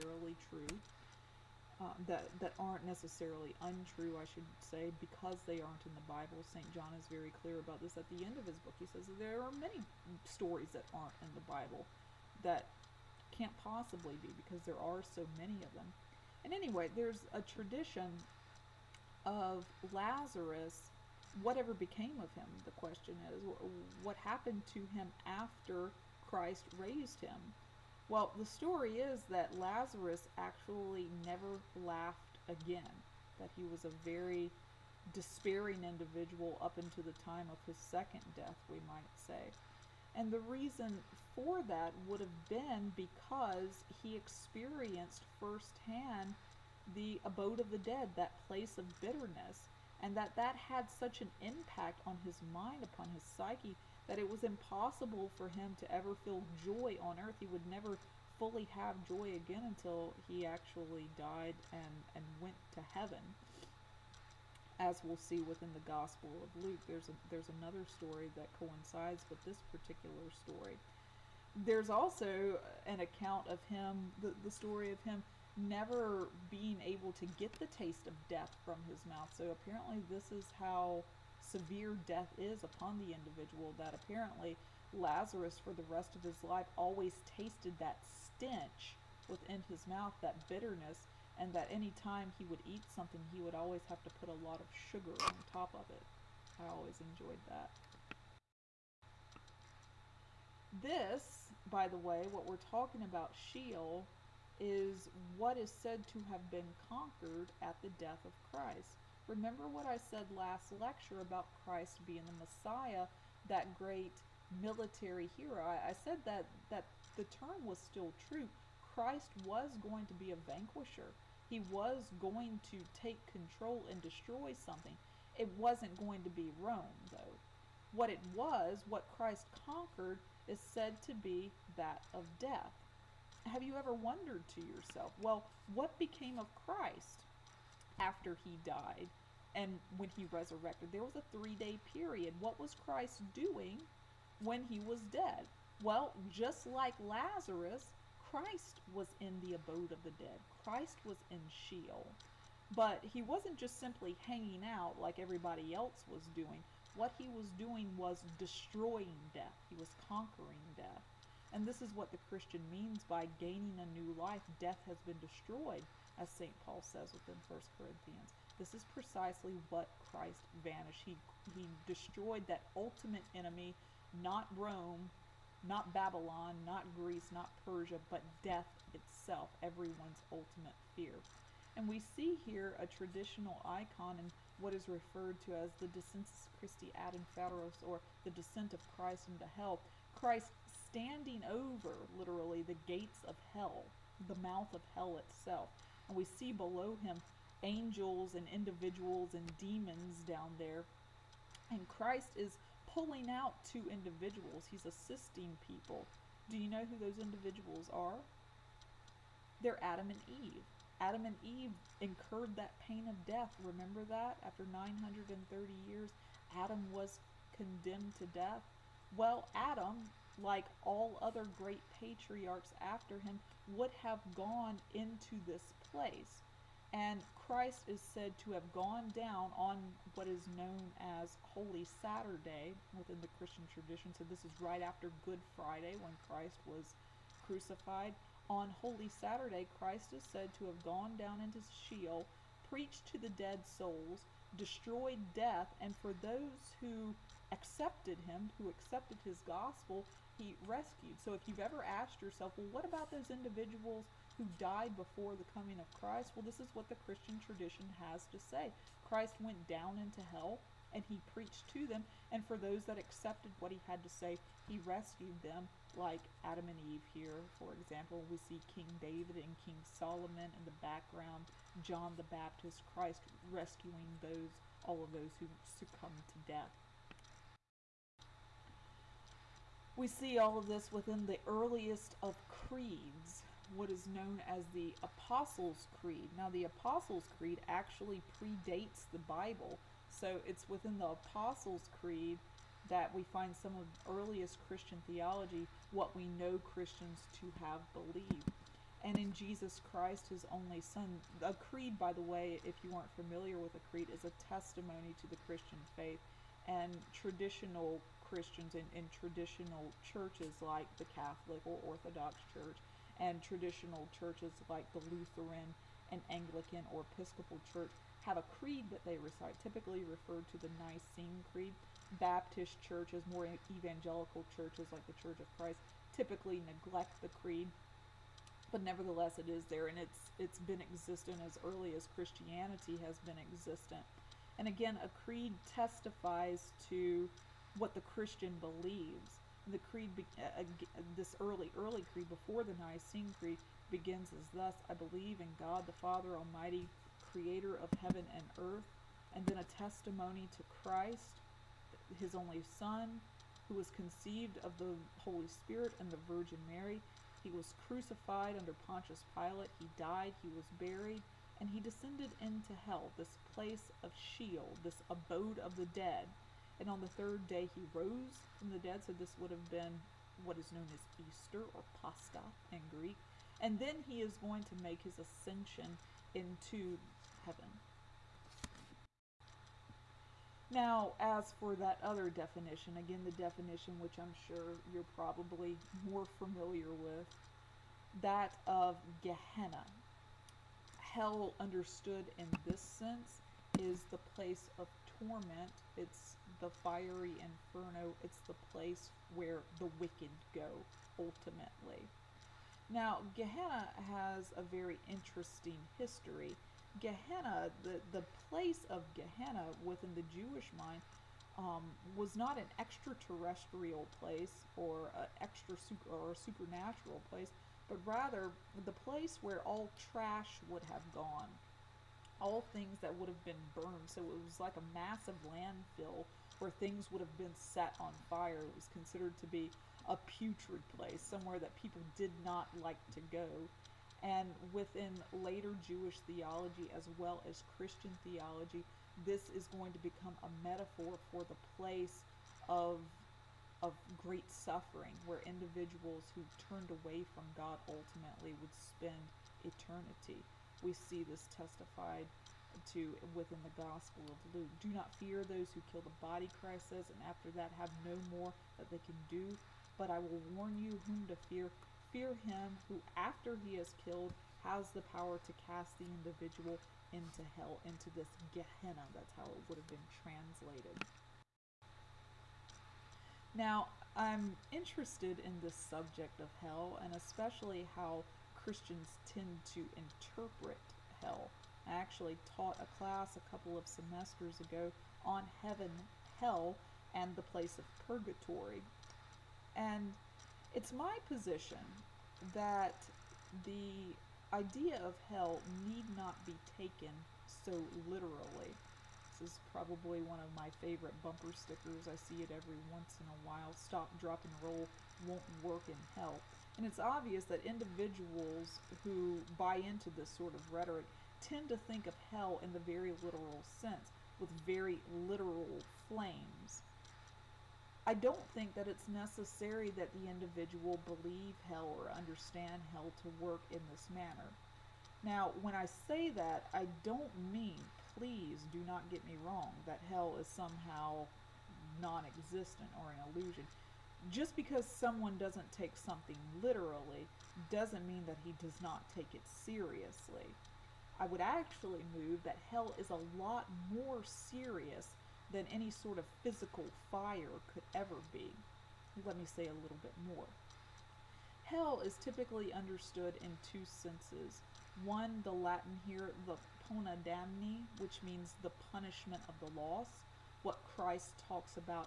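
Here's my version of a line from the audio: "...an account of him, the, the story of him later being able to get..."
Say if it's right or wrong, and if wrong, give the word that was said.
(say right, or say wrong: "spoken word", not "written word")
wrong: "never", not "later".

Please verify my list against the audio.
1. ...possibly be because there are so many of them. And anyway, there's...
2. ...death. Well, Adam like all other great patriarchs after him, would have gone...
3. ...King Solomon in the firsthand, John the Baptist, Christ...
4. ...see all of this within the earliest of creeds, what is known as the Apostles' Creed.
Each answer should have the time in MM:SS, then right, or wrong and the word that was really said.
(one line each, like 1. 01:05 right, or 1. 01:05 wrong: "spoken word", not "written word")
1. 00:13 right
2. 03:38 right
3. 04:29 wrong: "background", not "firsthand"
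4. 04:40 right.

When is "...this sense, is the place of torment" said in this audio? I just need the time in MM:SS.
06:32.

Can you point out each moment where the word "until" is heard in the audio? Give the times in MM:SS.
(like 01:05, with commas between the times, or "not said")
00:36, 00:59.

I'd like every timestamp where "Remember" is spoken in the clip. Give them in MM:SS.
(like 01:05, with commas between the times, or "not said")
01:49, 03:33.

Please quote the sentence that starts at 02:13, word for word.
Have you ever wondered to yourself, well, what became of Christ after he died and when he resurrected?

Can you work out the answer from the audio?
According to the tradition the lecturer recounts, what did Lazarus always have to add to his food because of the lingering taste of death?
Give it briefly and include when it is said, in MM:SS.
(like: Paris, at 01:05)
Sugar, at 01:34.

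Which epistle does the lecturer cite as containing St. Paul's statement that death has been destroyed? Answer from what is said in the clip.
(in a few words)
1 Corinthians.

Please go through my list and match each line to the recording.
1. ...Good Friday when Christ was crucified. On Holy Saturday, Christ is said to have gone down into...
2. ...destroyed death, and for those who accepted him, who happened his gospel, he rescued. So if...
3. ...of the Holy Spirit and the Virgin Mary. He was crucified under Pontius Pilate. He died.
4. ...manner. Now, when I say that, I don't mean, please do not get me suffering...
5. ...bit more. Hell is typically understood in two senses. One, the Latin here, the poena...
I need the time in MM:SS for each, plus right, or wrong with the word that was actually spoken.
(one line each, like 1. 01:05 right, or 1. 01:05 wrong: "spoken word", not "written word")
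1. 03:55 right
2. 04:04 wrong: "accepted", not "happened"
3. 05:54 right
4. 08:44 wrong: "wrong", not "suffering"
5. 09:10 right.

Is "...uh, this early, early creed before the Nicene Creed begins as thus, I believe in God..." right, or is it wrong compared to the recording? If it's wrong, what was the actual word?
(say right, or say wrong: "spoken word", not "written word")
right.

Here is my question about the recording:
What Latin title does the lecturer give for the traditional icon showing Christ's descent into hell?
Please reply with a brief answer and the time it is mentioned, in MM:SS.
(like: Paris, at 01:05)
Descensus Christi ad inferos, at 03:05.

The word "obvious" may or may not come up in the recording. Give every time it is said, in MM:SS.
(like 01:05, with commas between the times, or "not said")
08:26.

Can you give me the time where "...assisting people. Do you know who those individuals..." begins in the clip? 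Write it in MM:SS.
03:24.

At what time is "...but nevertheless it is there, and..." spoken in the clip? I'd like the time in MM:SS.
05:28.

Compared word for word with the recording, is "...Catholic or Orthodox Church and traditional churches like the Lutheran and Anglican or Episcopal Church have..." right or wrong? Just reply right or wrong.
right.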